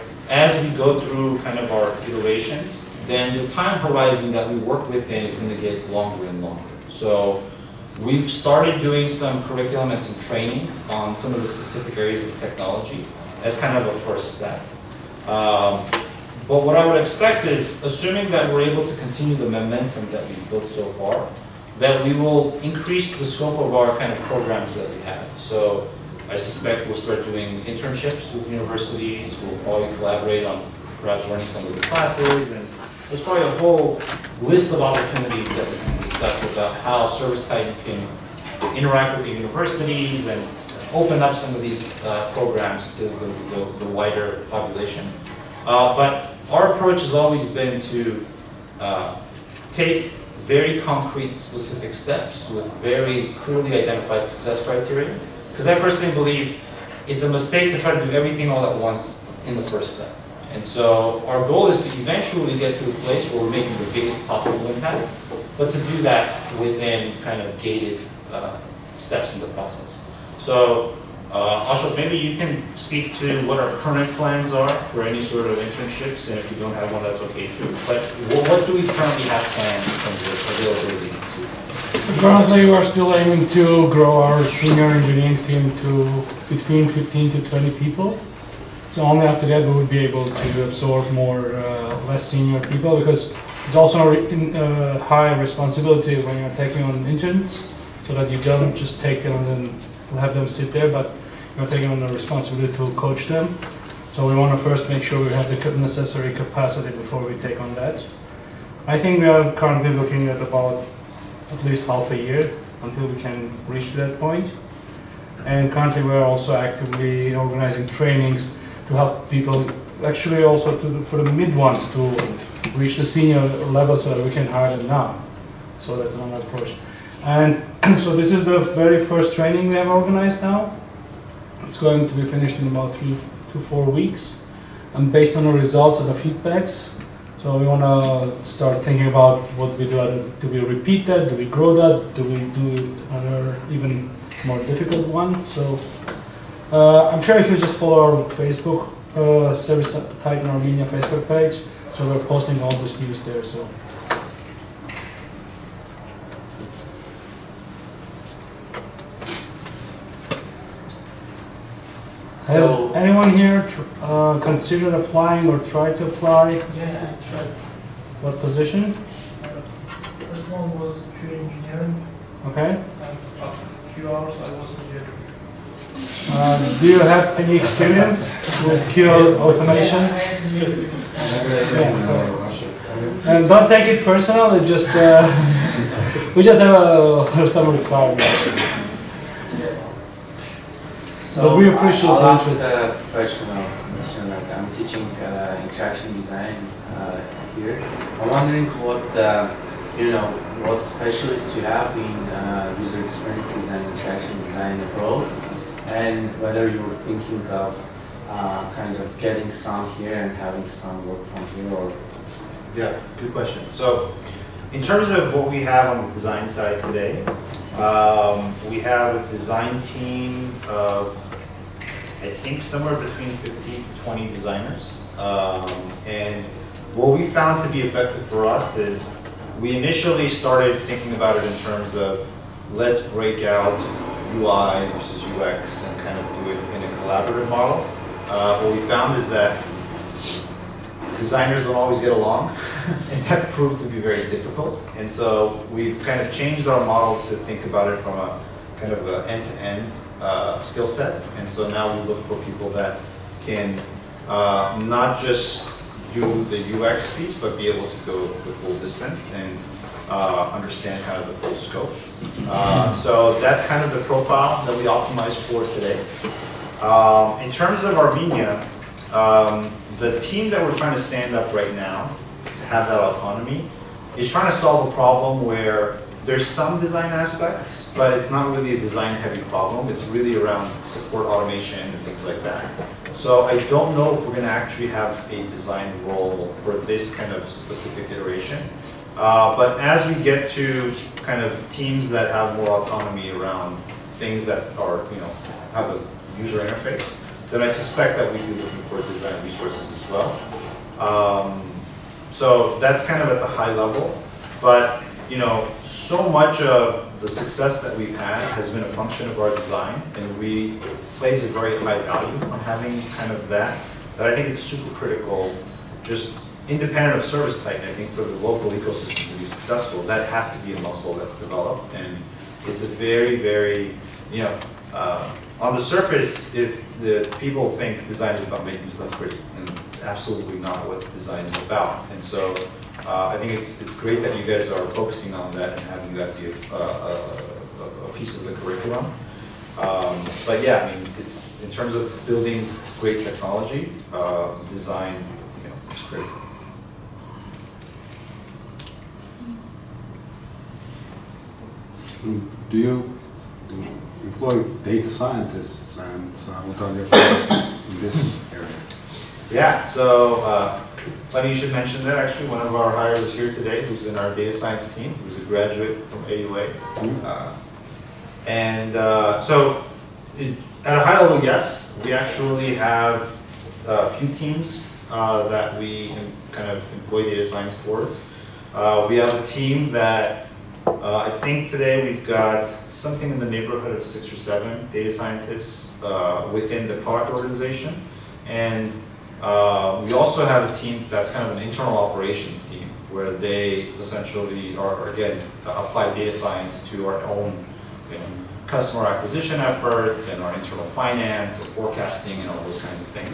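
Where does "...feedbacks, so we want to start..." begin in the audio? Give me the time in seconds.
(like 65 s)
136 s.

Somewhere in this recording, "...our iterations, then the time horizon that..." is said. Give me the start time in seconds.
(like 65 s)
1 s.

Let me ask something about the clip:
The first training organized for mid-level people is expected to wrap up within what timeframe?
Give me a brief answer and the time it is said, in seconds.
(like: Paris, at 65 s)
3 to 4 weeks, at 132 s.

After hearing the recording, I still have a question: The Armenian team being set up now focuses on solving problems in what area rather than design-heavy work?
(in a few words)
Support automation.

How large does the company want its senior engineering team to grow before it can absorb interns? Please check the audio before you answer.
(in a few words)
15 to 20 people.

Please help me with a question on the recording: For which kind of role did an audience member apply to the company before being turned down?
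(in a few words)
QA engineering.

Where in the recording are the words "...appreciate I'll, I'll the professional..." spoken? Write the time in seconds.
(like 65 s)
191 s.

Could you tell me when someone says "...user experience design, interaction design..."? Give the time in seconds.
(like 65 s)
202 s.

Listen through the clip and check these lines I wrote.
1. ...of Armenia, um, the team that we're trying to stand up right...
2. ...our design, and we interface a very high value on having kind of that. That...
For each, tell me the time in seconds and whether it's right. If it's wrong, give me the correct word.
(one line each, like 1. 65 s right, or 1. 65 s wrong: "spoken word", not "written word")
1. 267 s right
2. 309 s wrong: "place", not "interface".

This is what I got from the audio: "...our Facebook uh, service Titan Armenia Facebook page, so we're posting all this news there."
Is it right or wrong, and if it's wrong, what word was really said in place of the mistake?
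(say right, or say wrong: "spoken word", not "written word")
right.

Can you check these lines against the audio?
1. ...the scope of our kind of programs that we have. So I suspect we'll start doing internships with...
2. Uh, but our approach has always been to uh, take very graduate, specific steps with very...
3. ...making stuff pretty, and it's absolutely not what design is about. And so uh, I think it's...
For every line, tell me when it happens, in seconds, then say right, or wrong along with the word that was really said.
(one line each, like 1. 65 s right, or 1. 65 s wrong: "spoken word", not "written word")
1. 23 s right
2. 45 s wrong: "concrete", not "graduate"
3. 328 s right.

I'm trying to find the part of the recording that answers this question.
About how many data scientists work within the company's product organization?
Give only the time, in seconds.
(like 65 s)
384 s.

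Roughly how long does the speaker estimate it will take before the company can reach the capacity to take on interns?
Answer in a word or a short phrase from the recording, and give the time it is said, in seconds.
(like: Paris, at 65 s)
half a year, at 111 s.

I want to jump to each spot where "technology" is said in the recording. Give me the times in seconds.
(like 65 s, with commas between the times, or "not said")
12 s, 343 s.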